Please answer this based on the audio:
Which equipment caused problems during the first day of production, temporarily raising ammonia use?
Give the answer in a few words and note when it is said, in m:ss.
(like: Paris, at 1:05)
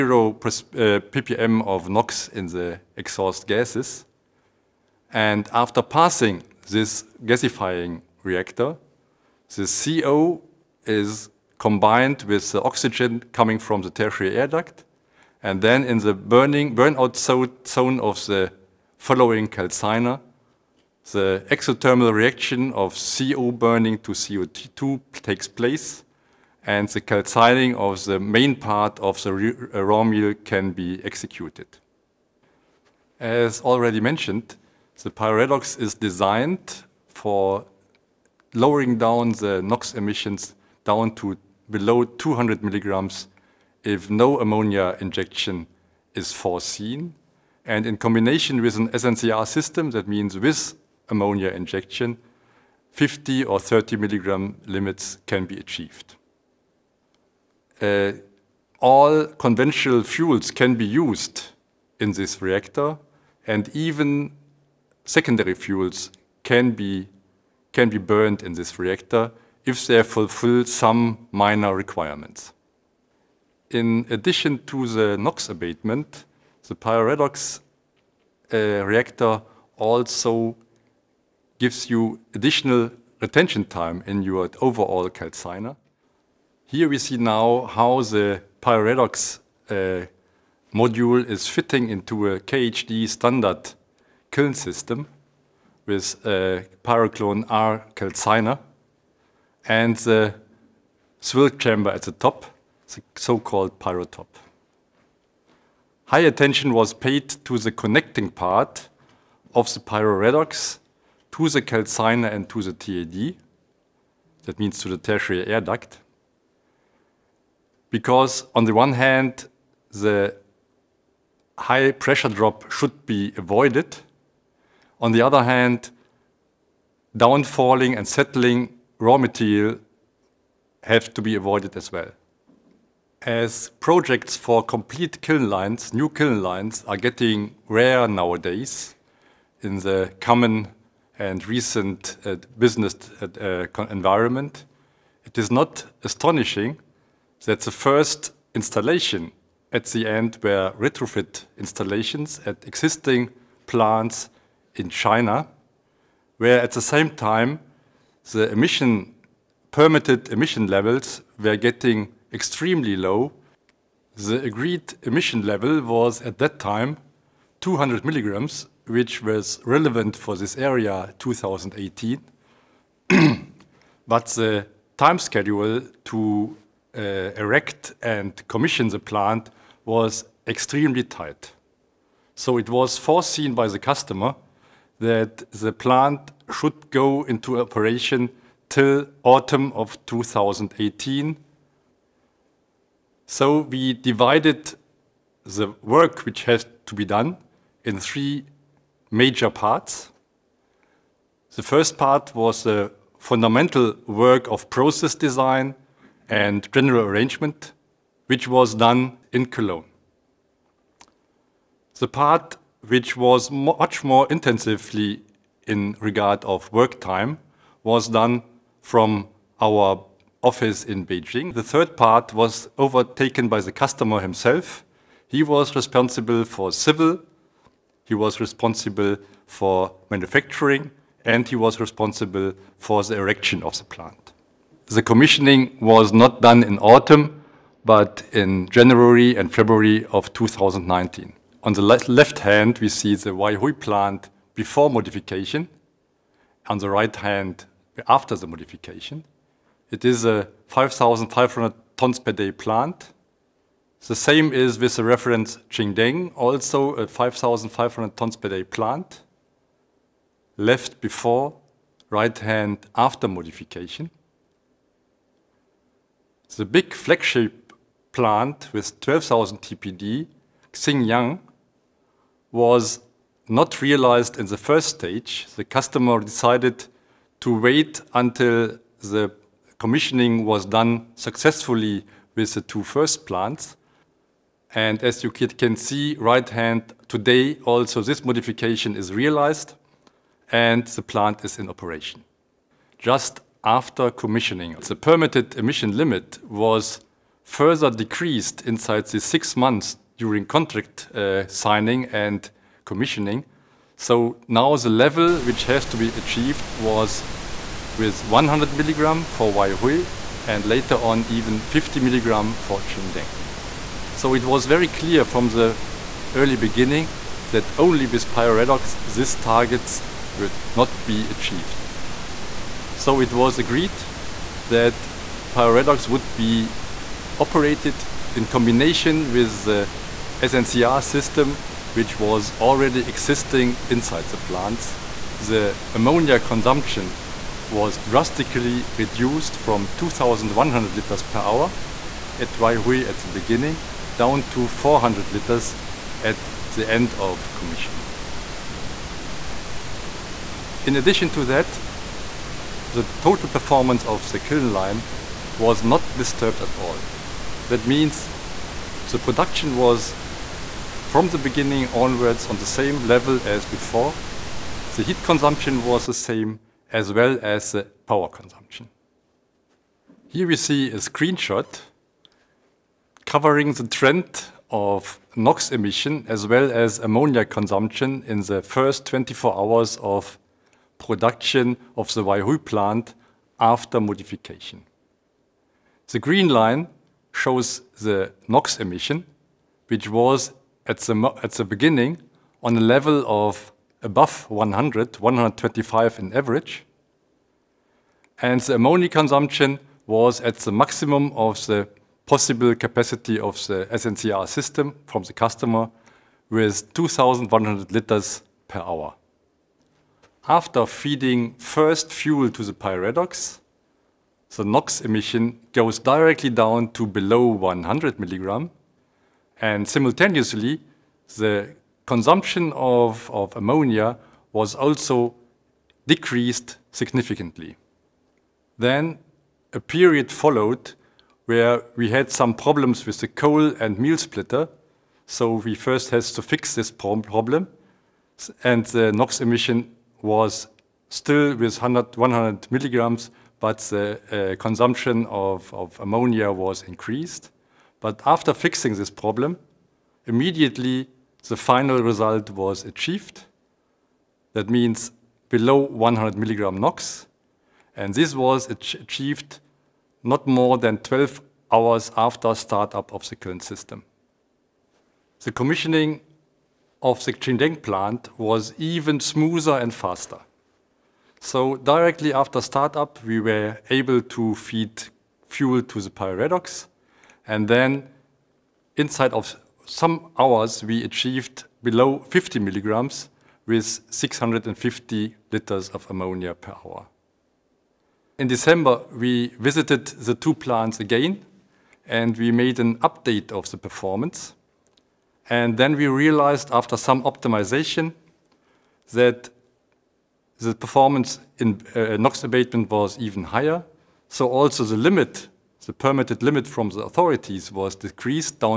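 coal and meal splitter, at 7:13.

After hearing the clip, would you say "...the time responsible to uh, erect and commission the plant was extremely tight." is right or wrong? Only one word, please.
wrong.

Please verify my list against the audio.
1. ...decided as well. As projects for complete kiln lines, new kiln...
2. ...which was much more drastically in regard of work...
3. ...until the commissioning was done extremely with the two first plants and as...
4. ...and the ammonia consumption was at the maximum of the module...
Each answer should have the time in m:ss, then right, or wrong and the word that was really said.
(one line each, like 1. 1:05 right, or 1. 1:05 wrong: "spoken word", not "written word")
1. 2:11 wrong: "avoided", not "decided"
2. 3:32 wrong: "intensively", not "drastically"
3. 4:38 wrong: "successfully", not "extremely"
4. 6:38 wrong: "possible", not "module".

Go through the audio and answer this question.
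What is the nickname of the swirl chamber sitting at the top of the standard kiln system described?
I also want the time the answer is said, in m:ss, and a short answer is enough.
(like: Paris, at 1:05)
pyrotop, at 1:43.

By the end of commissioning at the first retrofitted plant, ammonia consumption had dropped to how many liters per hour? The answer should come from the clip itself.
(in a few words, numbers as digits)
400.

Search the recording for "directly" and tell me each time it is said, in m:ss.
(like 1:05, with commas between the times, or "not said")
6:55, 7:51.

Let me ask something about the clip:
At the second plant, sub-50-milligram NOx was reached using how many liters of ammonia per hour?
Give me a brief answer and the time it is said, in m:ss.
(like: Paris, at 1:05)
650, at 8:04.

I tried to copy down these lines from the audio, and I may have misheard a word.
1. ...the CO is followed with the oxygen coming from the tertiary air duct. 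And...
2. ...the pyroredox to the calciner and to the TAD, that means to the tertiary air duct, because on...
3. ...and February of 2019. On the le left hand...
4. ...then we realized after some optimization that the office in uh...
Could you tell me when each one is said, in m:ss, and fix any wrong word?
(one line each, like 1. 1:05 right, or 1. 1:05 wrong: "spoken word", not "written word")
1. 0:09 wrong: "combined", not "followed"
2. 1:49 right
3. 3:59 right
4. 8:15 wrong: "performance", not "office".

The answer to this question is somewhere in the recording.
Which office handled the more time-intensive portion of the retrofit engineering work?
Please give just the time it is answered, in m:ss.
3:41.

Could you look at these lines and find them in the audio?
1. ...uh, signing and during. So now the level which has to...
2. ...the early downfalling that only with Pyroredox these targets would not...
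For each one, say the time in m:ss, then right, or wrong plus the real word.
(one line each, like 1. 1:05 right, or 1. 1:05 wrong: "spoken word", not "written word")
1. 5:01 wrong: "commissioning", not "during"
2. 5:15 wrong: "beginning", not "downfalling".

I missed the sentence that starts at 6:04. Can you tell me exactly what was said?
The heat consumption was the same as well as the power consumption.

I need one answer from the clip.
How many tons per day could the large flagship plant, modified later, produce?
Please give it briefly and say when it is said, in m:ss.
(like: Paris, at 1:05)
12,000, at 4:29.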